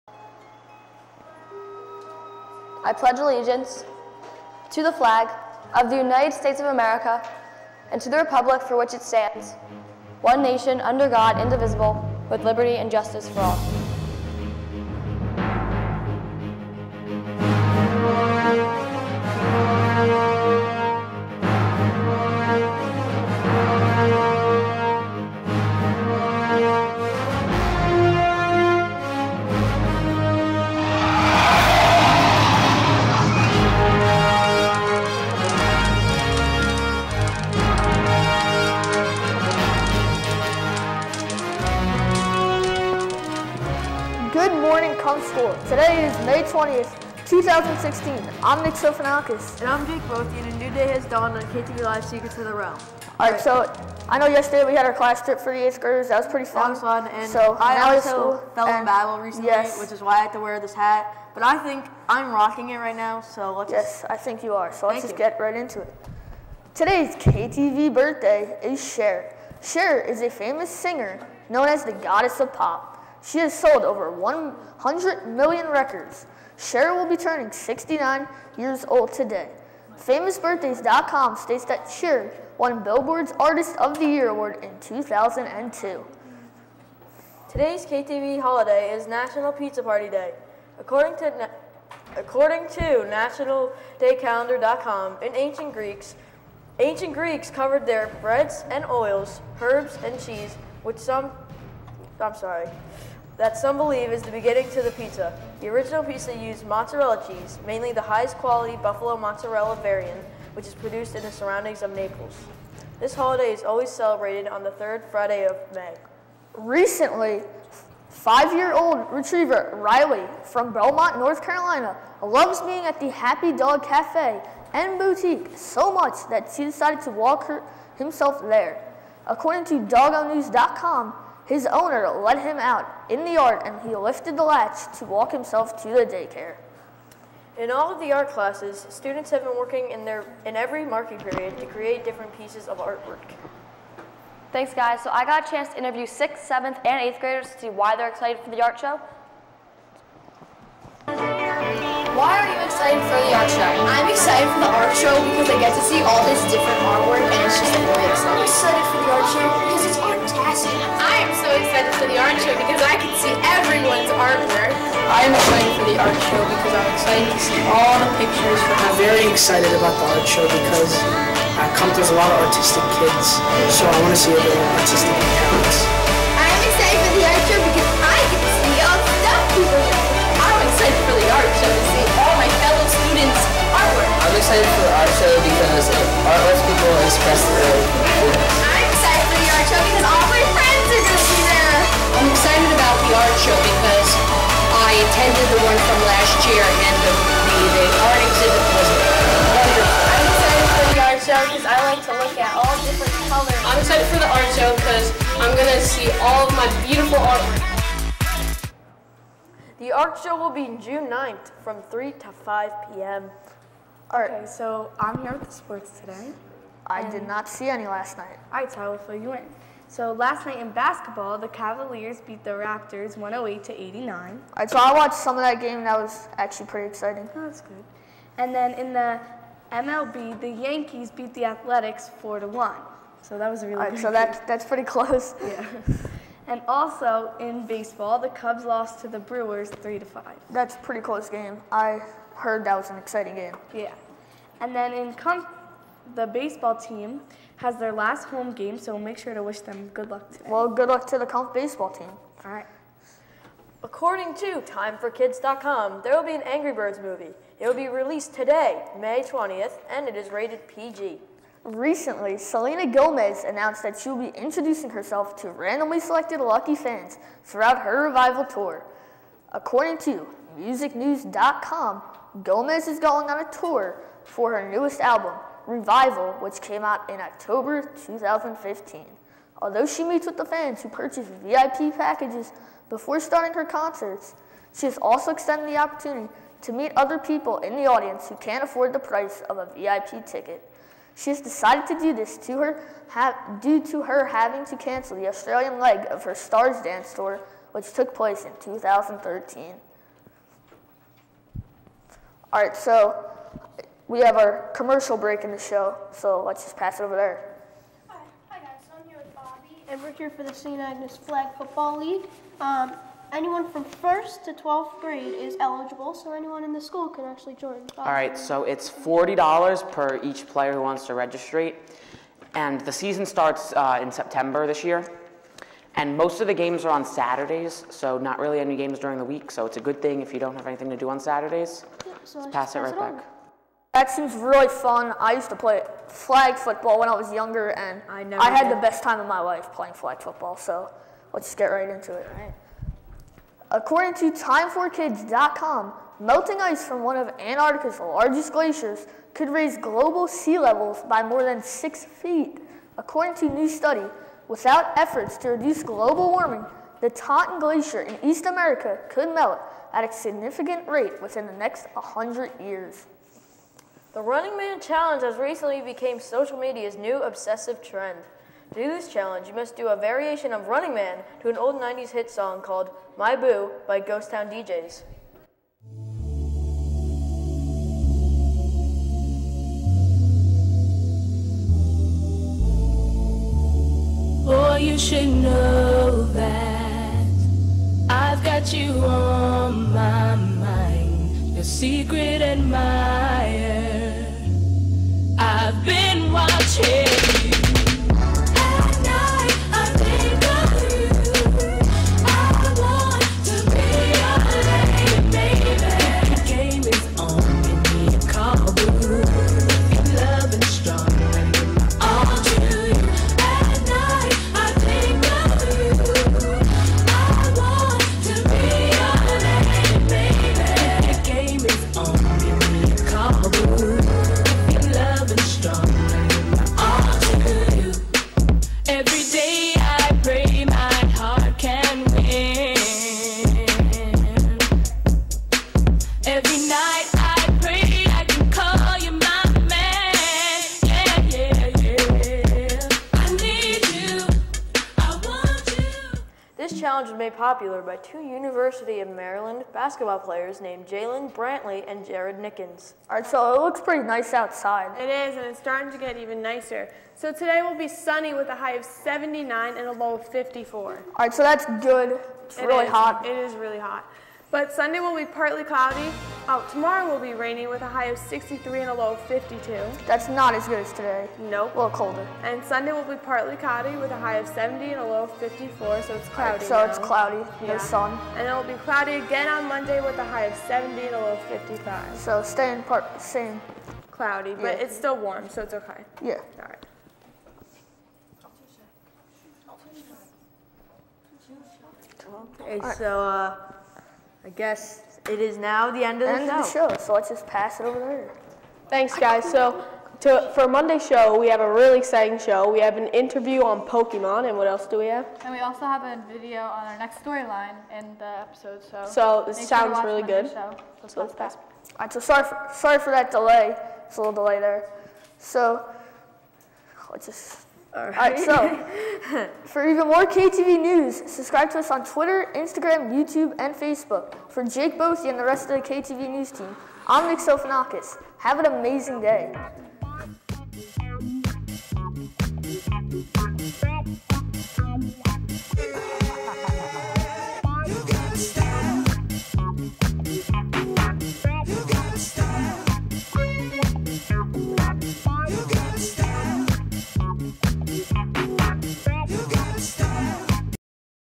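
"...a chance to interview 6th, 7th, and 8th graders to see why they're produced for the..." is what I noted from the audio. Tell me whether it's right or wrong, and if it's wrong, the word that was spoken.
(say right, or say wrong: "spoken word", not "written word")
wrong: "excited", not "produced".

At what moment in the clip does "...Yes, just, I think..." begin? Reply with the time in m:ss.
1:03.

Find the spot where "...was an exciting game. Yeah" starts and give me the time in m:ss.
4:02.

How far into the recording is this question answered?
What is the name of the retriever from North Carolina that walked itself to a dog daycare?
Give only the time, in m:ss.
1:59.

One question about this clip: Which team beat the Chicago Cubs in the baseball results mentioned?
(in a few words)
Brewers.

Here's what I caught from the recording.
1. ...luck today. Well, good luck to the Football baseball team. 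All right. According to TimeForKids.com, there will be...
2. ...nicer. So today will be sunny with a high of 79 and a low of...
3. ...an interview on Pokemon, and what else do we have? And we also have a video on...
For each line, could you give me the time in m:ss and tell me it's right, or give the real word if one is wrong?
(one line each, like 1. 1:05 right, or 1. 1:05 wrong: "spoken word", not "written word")
1. 4:10 wrong: "Kumpf", not "Football"
2. 7:36 right
3. 8:22 right.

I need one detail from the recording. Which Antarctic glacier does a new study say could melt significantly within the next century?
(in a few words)
Totten Glacier.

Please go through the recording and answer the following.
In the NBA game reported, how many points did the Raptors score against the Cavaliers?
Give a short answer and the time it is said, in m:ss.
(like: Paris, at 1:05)
89, at 3:43.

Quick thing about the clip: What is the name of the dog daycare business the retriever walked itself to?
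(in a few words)
Happy Dog Cafe and Boutique.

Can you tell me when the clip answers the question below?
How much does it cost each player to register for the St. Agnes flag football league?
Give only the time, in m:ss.
5:18.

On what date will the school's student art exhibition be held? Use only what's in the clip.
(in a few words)
June 9th.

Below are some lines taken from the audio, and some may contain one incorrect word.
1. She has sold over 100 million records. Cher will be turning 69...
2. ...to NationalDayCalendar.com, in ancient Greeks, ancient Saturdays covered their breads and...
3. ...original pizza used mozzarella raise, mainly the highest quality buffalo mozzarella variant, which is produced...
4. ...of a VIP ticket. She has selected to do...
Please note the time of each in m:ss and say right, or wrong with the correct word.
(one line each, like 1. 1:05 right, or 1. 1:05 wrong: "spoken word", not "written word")
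1. 1:13 right
2. 1:32 wrong: "Greeks", not "Saturdays"
3. 1:45 wrong: "cheese", not "raise"
4. 4:49 wrong: "decided", not "selected".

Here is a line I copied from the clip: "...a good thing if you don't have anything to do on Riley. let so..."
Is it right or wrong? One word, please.
wrong.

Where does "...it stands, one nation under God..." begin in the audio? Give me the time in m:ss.
0:08.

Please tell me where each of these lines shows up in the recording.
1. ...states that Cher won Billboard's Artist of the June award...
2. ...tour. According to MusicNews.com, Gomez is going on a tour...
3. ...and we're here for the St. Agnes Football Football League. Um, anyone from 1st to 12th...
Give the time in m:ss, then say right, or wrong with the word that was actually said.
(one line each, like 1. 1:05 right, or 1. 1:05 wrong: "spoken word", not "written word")
1. 1:21 wrong: "Year", not "June"
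2. 4:28 right
3. 5:09 wrong: "Flag", not "Football".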